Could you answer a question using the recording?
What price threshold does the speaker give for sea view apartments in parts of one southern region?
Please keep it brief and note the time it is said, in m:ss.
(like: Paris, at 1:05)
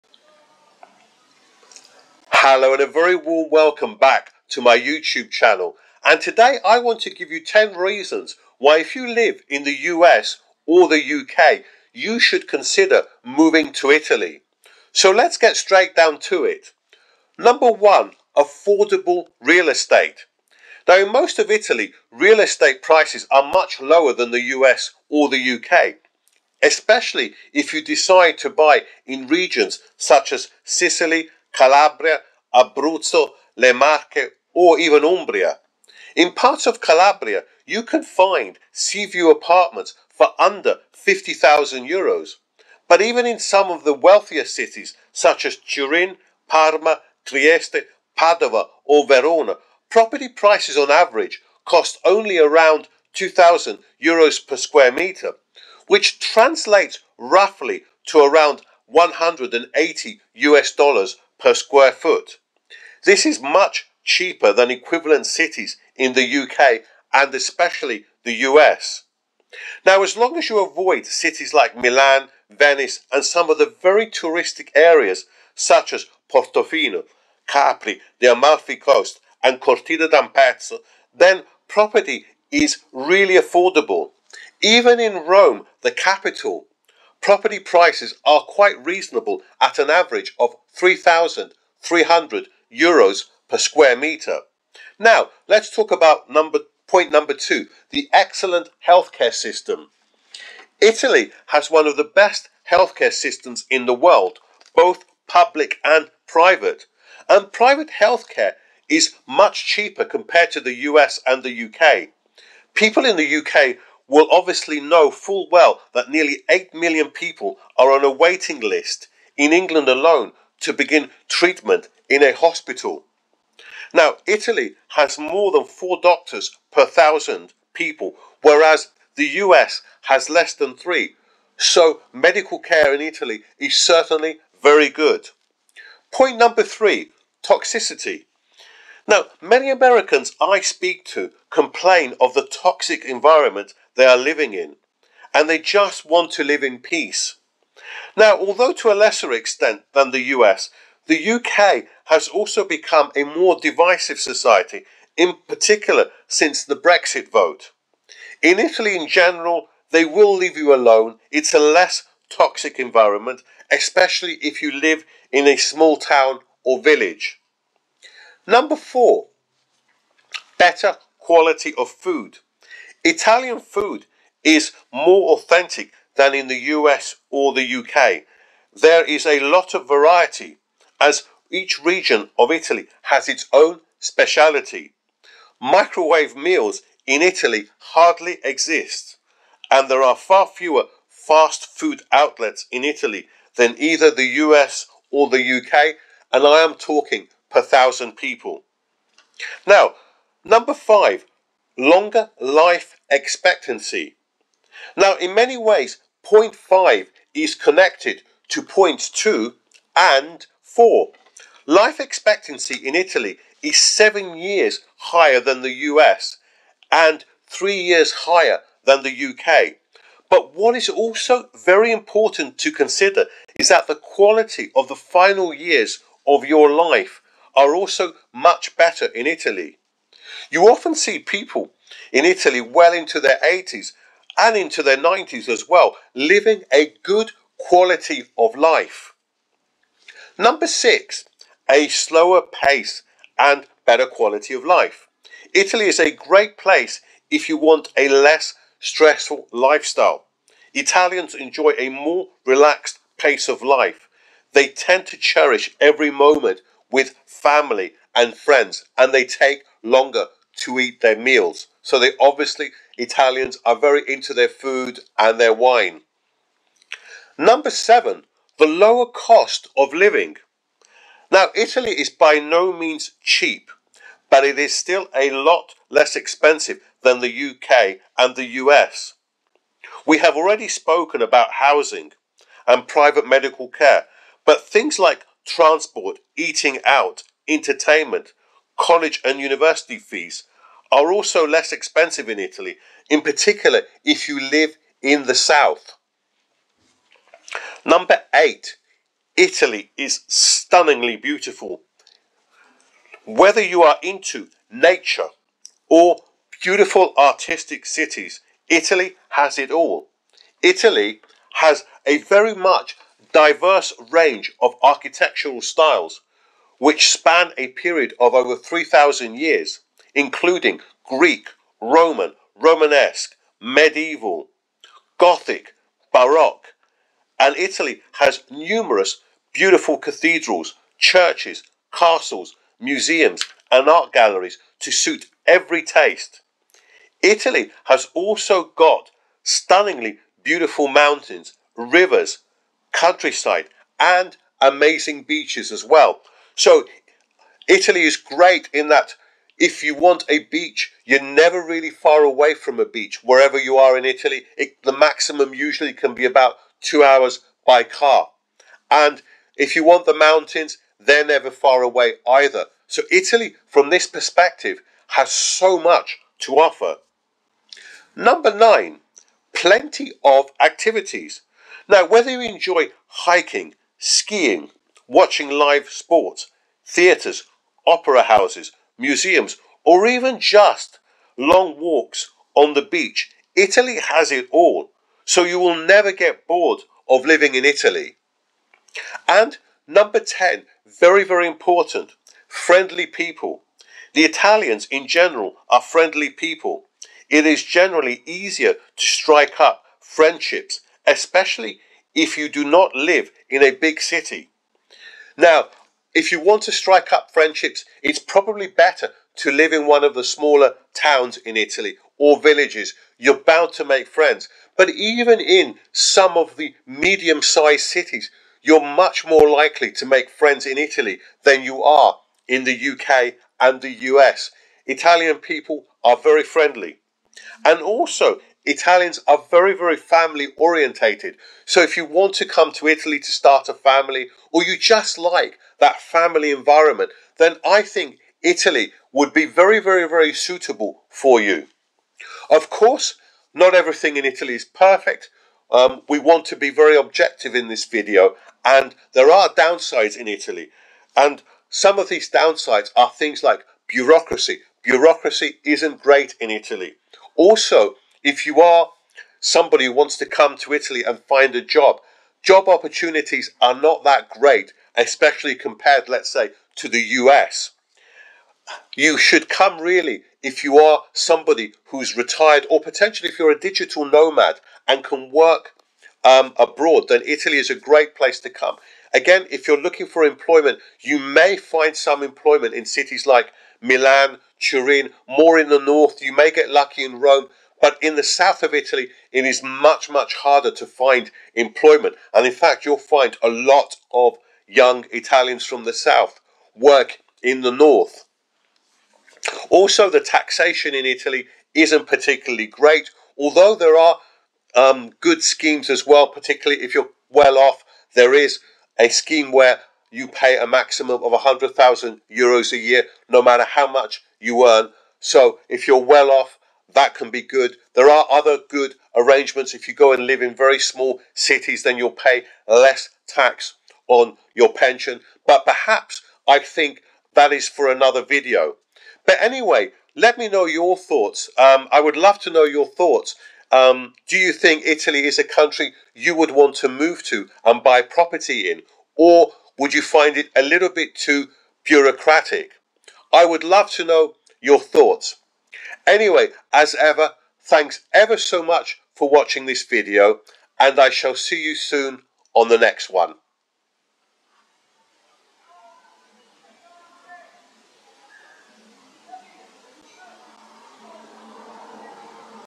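under 50,000 euros, at 0:40.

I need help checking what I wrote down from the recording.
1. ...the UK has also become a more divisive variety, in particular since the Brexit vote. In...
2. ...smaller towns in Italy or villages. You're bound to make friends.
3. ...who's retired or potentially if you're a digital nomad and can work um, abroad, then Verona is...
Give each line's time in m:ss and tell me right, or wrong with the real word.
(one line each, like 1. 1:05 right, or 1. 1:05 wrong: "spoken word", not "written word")
1. 2:31 wrong: "society", not "variety"
2. 6:50 right
3. 7:51 wrong: "Italy", not "Verona".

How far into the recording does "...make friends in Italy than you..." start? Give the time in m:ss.
7:00.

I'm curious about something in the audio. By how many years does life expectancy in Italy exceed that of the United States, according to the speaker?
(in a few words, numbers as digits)
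7 years.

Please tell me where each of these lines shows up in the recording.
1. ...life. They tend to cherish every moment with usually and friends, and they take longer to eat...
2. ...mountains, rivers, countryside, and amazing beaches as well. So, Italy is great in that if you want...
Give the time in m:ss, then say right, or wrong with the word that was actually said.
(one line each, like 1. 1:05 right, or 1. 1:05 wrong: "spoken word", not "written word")
1. 4:13 wrong: "family", not "usually"
2. 5:40 right.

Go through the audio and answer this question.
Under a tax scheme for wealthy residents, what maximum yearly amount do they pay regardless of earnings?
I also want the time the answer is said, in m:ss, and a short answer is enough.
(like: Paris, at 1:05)
100,000 euros, at 8:31.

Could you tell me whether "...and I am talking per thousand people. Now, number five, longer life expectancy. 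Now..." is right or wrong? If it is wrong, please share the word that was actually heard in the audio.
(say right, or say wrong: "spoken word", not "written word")
right.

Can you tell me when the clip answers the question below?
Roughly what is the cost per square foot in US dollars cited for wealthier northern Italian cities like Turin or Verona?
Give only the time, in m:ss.
0:58.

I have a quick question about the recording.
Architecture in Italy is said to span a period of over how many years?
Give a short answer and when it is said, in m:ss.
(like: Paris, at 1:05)
3,000 years, at 5:18.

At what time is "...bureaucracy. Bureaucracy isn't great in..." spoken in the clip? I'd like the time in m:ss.
7:33.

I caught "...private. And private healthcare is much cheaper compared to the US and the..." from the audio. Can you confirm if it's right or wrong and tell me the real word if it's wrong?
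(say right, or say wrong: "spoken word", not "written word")
right.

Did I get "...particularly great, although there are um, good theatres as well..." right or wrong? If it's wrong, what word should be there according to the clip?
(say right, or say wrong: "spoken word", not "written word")
wrong: "schemes", not "theatres".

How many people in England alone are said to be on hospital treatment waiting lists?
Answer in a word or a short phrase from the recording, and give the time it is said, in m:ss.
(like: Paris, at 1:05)
nearly 8 million, at 1:56.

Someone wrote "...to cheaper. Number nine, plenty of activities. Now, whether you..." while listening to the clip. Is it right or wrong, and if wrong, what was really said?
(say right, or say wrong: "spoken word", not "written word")
wrong: "offer", not "cheaper".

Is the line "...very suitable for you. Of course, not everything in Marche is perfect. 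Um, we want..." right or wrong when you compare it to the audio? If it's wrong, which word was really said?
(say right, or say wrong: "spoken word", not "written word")
wrong: "Italy", not "Marche".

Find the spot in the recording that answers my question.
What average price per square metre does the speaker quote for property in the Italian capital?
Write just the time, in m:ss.
1:30.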